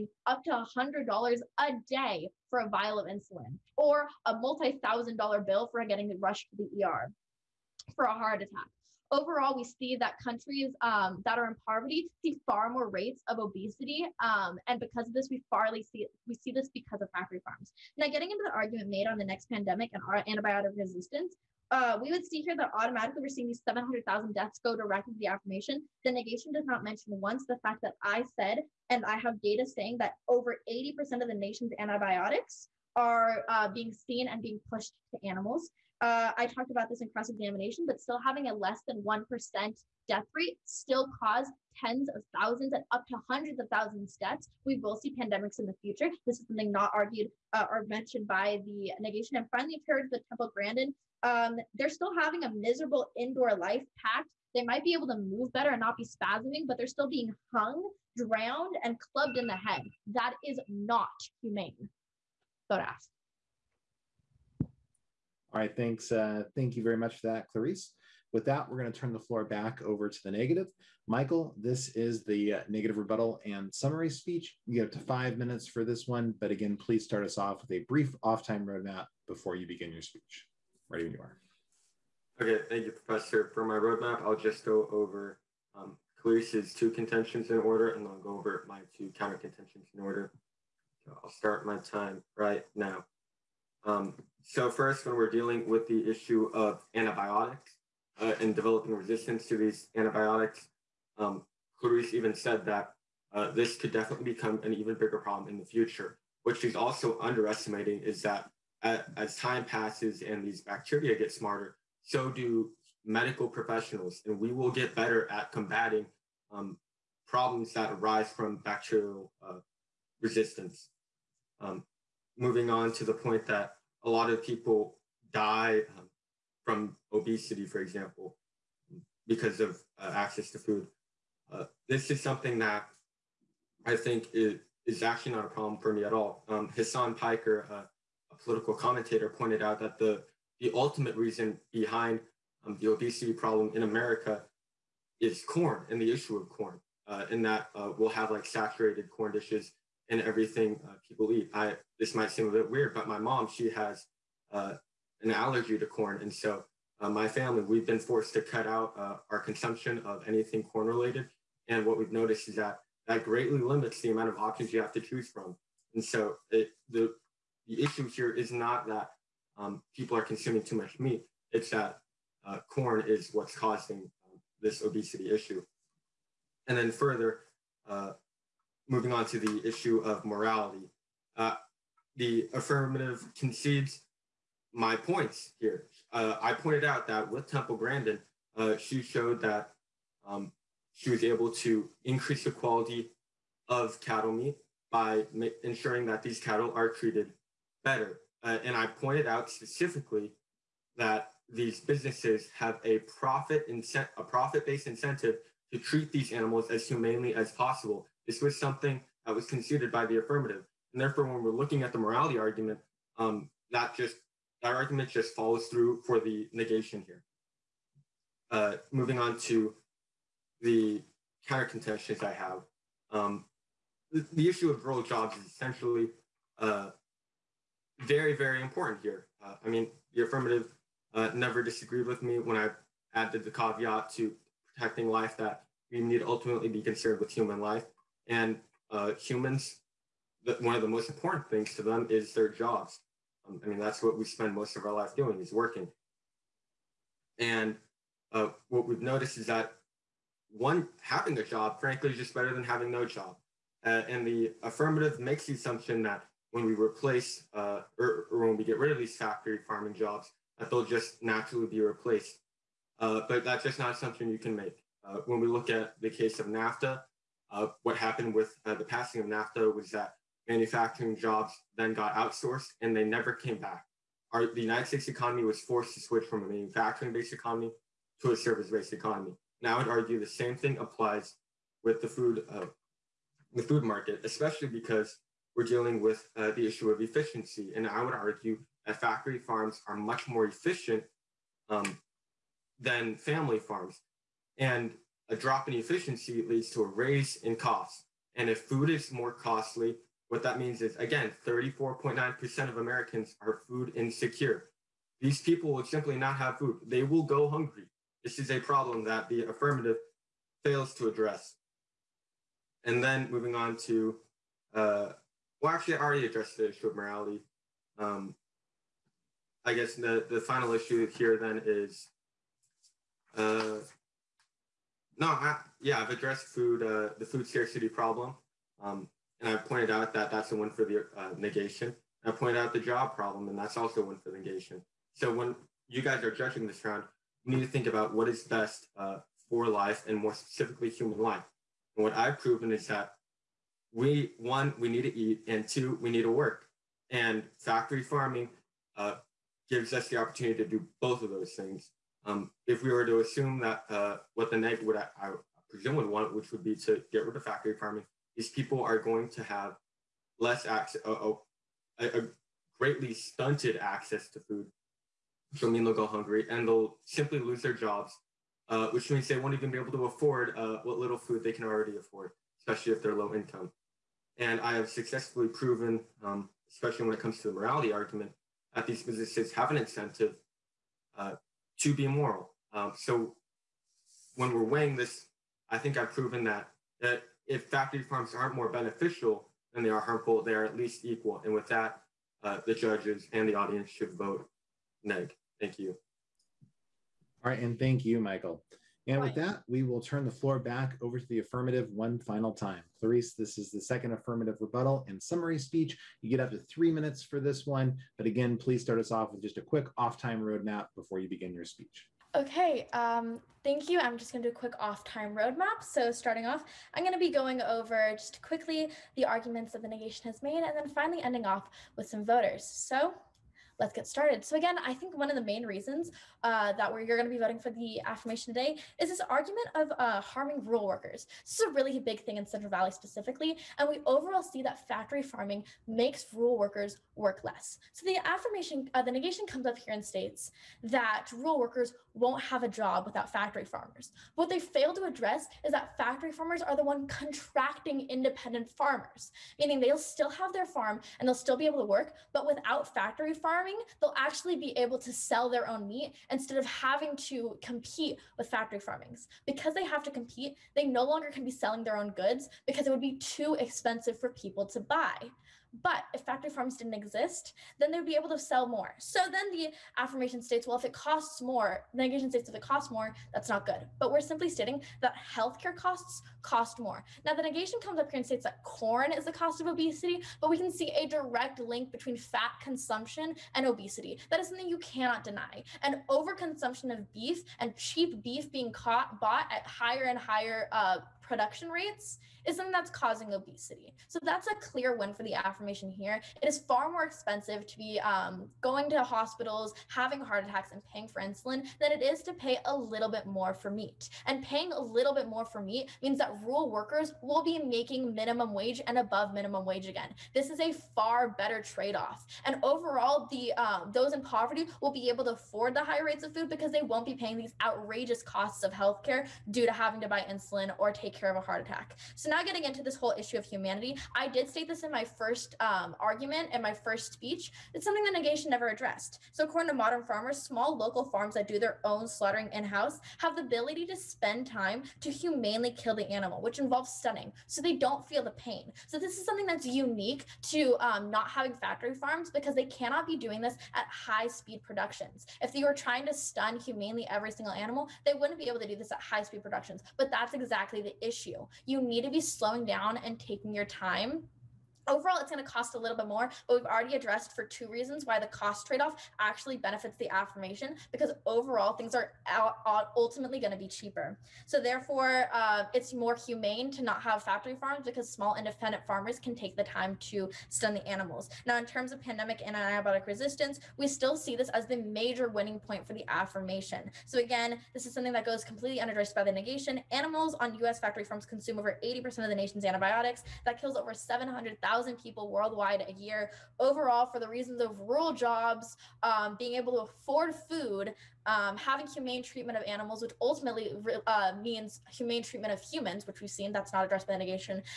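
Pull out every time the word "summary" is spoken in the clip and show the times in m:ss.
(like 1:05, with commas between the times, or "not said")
1:13, 6:45.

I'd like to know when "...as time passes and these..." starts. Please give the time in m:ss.
1:49.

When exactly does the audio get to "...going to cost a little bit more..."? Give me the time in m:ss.
9:15.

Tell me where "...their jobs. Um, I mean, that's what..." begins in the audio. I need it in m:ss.
4:02.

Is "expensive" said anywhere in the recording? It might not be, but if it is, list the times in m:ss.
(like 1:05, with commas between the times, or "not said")
7:43, 8:17.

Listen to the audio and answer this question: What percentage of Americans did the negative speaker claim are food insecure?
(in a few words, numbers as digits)
34.9%.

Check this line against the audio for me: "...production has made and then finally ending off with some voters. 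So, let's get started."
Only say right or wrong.
wrong.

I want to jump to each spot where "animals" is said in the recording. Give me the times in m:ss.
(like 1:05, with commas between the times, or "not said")
0:35, 3:26, 8:56, 9:07, 9:30, 9:39, 9:52.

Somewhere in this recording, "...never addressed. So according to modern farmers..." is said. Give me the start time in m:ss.
8:48.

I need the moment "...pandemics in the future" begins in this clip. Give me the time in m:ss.
0:45.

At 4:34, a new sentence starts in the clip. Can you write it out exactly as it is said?
Our, the United States economy was forced to switch from a manufacturing based economy to a service based economy.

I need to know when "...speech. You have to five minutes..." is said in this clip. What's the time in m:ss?
1:14.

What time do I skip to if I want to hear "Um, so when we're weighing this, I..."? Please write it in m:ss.
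6:22.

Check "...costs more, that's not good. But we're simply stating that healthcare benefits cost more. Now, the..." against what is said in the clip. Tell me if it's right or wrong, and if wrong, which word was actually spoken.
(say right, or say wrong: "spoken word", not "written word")
wrong: "costs", not "benefits".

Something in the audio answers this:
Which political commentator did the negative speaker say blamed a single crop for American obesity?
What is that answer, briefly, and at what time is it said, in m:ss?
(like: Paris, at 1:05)
Hasan Piker, at 2:16.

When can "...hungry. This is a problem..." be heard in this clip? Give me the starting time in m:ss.
5:07.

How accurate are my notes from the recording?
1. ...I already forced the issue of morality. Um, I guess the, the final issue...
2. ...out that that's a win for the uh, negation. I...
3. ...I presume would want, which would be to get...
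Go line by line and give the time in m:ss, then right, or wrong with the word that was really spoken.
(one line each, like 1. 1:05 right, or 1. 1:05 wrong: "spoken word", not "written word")
1. 5:15 wrong: "addressed", not "forced"
2. 5:29 right
3. 5:55 right.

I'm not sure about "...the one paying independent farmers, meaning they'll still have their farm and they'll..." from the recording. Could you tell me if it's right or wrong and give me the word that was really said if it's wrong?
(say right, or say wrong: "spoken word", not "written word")
wrong: "contracting", not "paying".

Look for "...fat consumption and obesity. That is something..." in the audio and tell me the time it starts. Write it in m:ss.
8:02.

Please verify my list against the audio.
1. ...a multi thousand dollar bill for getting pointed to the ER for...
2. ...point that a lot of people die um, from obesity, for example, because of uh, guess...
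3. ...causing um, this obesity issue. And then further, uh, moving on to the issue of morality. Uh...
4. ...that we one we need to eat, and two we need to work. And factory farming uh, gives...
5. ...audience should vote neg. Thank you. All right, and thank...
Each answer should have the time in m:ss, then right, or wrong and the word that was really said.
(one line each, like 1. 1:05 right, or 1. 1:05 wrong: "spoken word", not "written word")
1. 0:04 wrong: "rushed", not "pointed"
2. 2:03 wrong: "access", not "guess"
3. 2:53 right
4. 5:42 right
5. 6:33 right.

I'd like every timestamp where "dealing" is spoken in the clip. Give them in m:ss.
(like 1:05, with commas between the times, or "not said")
1:35, 4:45.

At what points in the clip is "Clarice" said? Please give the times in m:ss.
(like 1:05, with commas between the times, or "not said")
1:07, 1:26, 1:41, 6:42.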